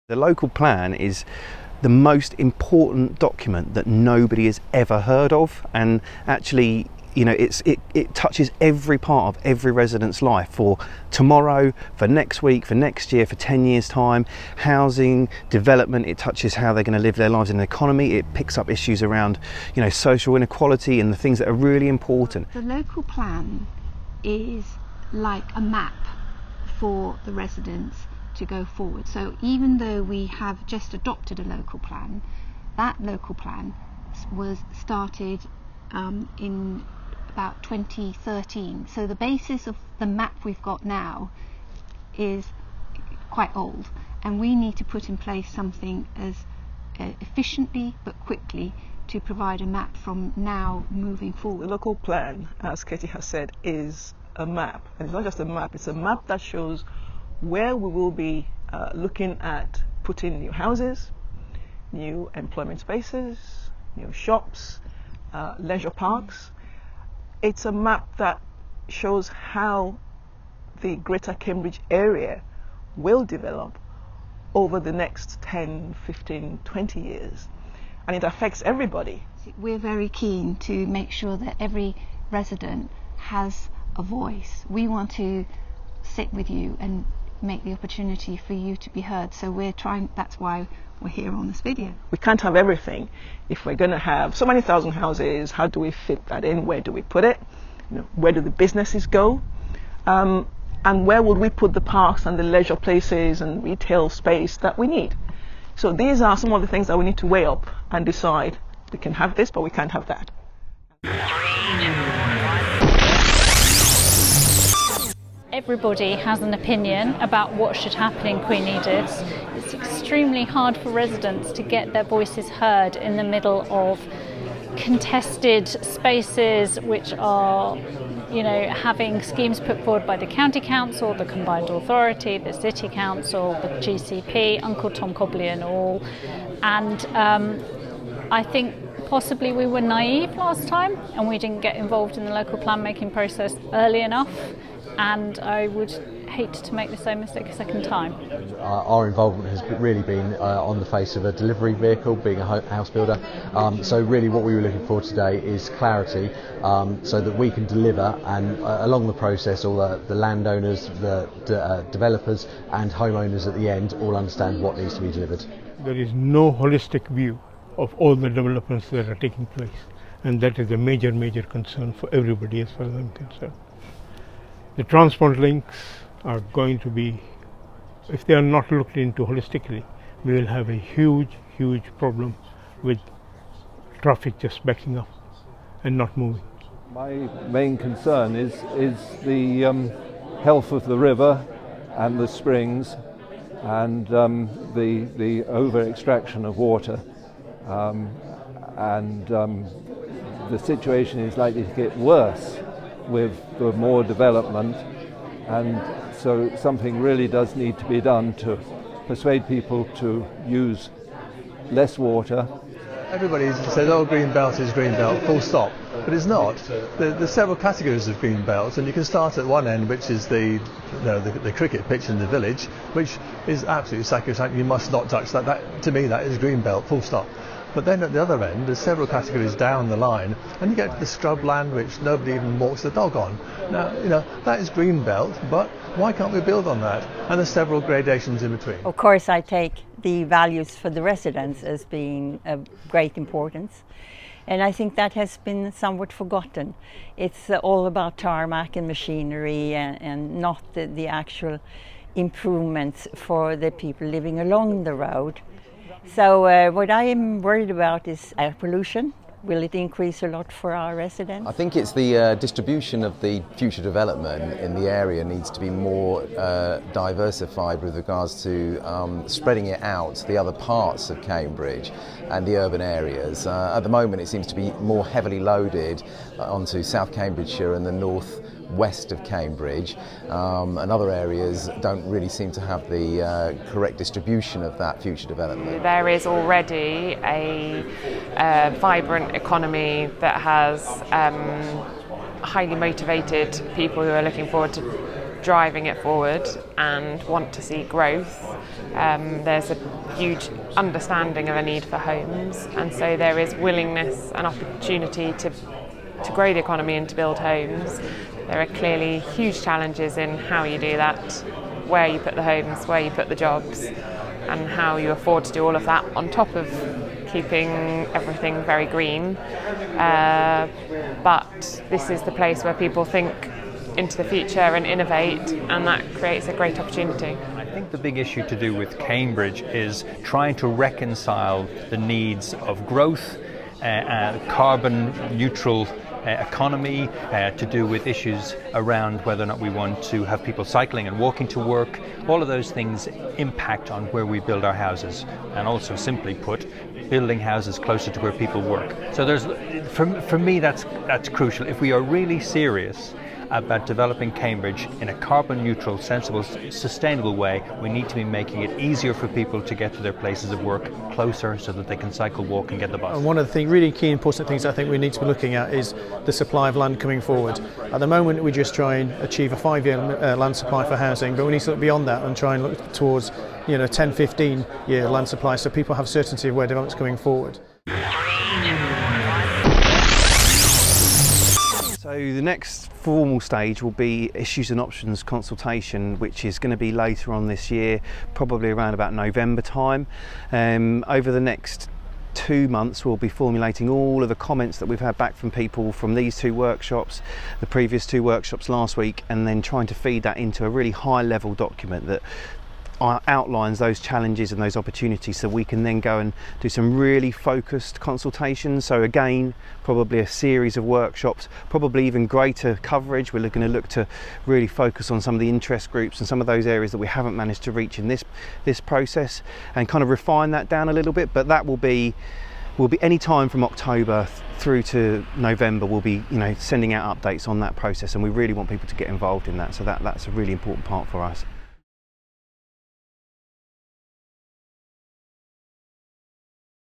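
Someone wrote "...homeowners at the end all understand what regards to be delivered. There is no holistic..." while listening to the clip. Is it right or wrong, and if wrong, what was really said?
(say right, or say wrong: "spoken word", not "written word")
wrong: "needs", not "regards".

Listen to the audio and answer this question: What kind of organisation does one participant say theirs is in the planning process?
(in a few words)
A house builder.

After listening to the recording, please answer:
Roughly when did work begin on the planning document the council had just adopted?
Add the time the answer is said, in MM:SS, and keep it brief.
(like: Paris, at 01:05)
2013, at 00:37.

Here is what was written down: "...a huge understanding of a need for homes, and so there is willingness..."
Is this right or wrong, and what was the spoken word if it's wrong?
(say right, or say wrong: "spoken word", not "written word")
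right.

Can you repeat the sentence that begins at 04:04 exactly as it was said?
And I think that has been somewhat forgotten.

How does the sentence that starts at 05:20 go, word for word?
Uh, but this is the place where people think into the future and innovate, and that creates a great opportunity.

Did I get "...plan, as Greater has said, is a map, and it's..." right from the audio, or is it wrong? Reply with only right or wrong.
wrong.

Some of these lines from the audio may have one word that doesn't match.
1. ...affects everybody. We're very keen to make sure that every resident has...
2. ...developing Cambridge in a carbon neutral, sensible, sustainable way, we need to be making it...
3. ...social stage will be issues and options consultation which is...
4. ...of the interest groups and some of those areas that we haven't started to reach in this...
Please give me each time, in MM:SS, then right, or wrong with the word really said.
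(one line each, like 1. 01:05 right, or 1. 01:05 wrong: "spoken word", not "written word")
1. 01:18 right
2. 05:53 right
3. 06:22 wrong: "formal", not "social"
4. 06:55 wrong: "managed", not "started".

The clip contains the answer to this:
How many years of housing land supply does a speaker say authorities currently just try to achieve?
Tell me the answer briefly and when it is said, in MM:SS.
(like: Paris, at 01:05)
5 years, at 06:09.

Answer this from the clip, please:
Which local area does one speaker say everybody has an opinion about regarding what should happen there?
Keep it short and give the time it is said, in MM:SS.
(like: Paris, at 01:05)
Queen Edith's, at 01:58.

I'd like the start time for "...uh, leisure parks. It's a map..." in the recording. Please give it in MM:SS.
01:05.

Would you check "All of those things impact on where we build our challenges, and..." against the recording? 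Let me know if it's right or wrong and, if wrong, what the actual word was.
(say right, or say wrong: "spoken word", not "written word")
wrong: "houses", not "challenges".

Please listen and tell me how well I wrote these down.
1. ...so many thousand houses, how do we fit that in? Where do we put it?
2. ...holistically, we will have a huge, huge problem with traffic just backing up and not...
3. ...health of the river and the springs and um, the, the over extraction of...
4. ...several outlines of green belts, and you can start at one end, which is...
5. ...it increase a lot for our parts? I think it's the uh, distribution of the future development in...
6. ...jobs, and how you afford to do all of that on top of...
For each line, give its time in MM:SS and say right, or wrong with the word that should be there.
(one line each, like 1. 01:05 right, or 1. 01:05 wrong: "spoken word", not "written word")
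1. 01:34 right
2. 02:59 right
3. 03:10 right
4. 03:37 wrong: "categories", not "outlines"
5. 04:19 wrong: "residents", not "parts"
6. 05:13 right.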